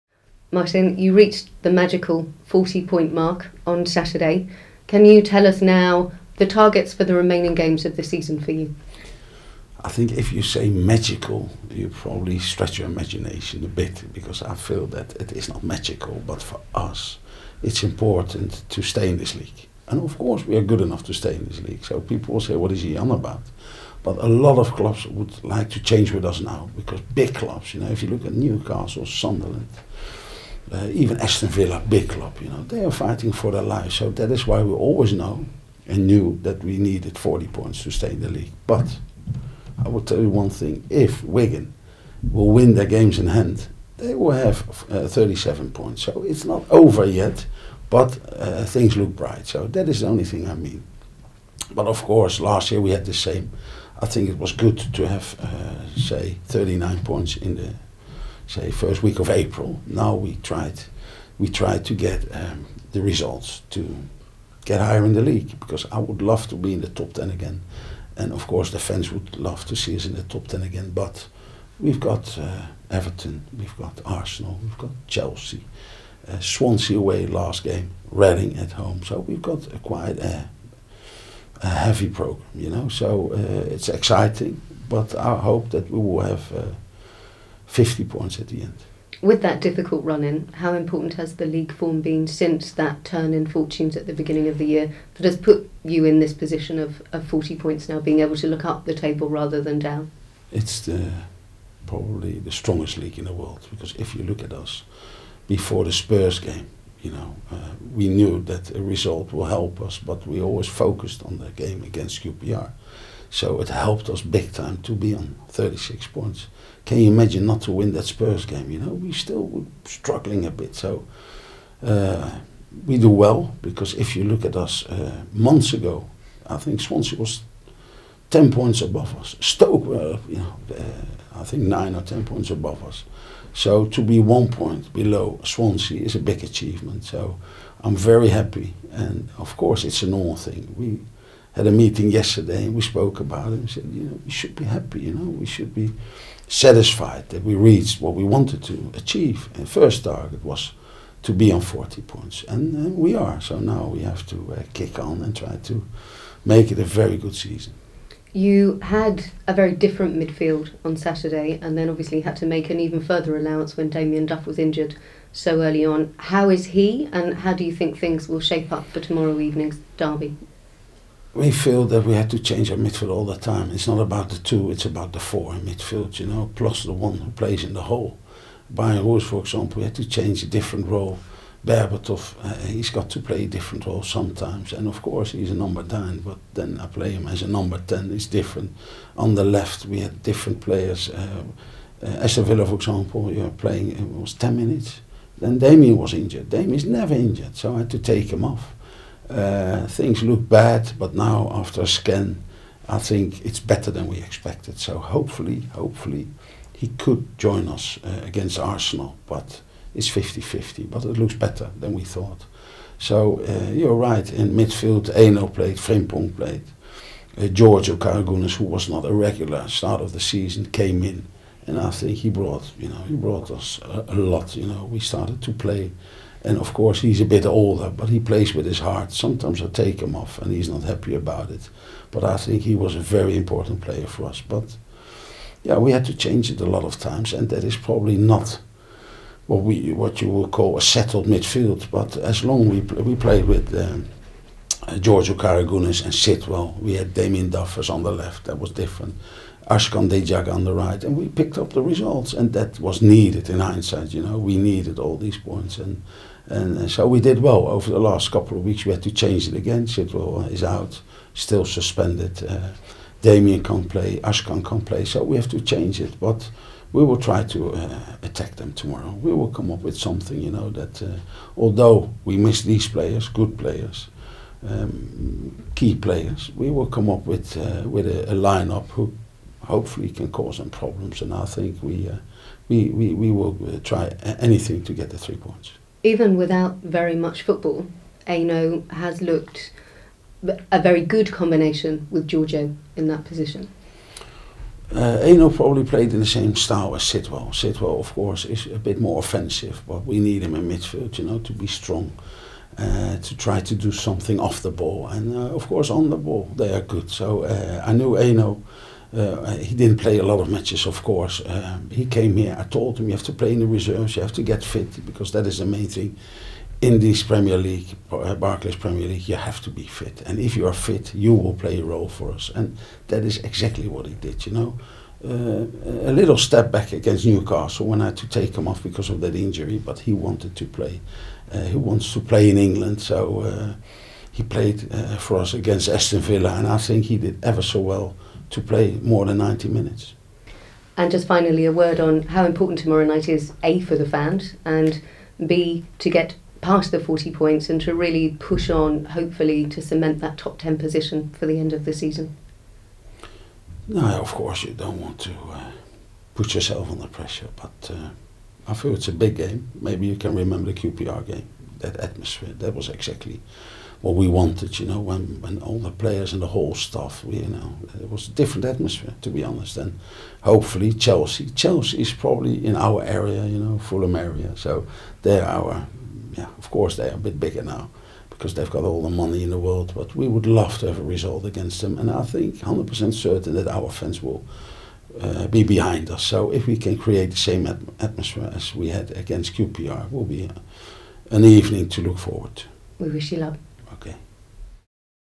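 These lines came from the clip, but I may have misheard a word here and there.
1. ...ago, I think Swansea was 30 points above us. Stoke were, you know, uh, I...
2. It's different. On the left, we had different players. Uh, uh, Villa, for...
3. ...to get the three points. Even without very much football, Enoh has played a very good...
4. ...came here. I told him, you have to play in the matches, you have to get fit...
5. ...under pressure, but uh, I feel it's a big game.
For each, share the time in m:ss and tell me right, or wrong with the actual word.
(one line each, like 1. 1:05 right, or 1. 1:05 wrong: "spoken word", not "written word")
1. 2:05 wrong: "10", not "30"
2. 3:08 right
3. 4:44 wrong: "looked", not "played"
4. 5:12 wrong: "reserves", not "matches"
5. 5:56 right.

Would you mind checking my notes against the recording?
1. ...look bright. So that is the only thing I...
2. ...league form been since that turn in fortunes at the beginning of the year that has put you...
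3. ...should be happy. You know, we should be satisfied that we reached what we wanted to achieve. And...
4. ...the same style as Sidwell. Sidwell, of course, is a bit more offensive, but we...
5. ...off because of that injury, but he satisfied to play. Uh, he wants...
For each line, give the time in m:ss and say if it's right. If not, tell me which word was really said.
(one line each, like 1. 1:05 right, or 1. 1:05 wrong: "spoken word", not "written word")
1. 0:48 right
2. 1:31 right
3. 2:24 right
4. 4:56 right
5. 5:28 wrong: "wanted", not "satisfied".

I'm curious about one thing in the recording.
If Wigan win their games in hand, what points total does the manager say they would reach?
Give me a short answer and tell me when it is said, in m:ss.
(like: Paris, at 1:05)
37, at 0:45.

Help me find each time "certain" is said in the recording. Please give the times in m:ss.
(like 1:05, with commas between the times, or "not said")
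6:23.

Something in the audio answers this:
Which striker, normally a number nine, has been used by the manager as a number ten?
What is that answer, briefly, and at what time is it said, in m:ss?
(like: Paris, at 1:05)
Berbatov, at 3:01.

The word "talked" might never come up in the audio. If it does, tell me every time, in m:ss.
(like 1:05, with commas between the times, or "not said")
not said.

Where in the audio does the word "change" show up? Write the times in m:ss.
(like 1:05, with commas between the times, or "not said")
0:25, 2:52, 3:00, 3:56, 4:19, 4:25.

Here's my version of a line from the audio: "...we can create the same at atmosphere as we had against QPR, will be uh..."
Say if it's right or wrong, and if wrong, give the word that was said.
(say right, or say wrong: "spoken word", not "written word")
right.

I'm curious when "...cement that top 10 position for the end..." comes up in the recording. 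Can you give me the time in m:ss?
5:49.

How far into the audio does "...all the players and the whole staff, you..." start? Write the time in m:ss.
6:05.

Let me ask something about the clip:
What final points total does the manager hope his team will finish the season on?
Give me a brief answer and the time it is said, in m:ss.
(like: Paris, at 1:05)
50, at 1:27.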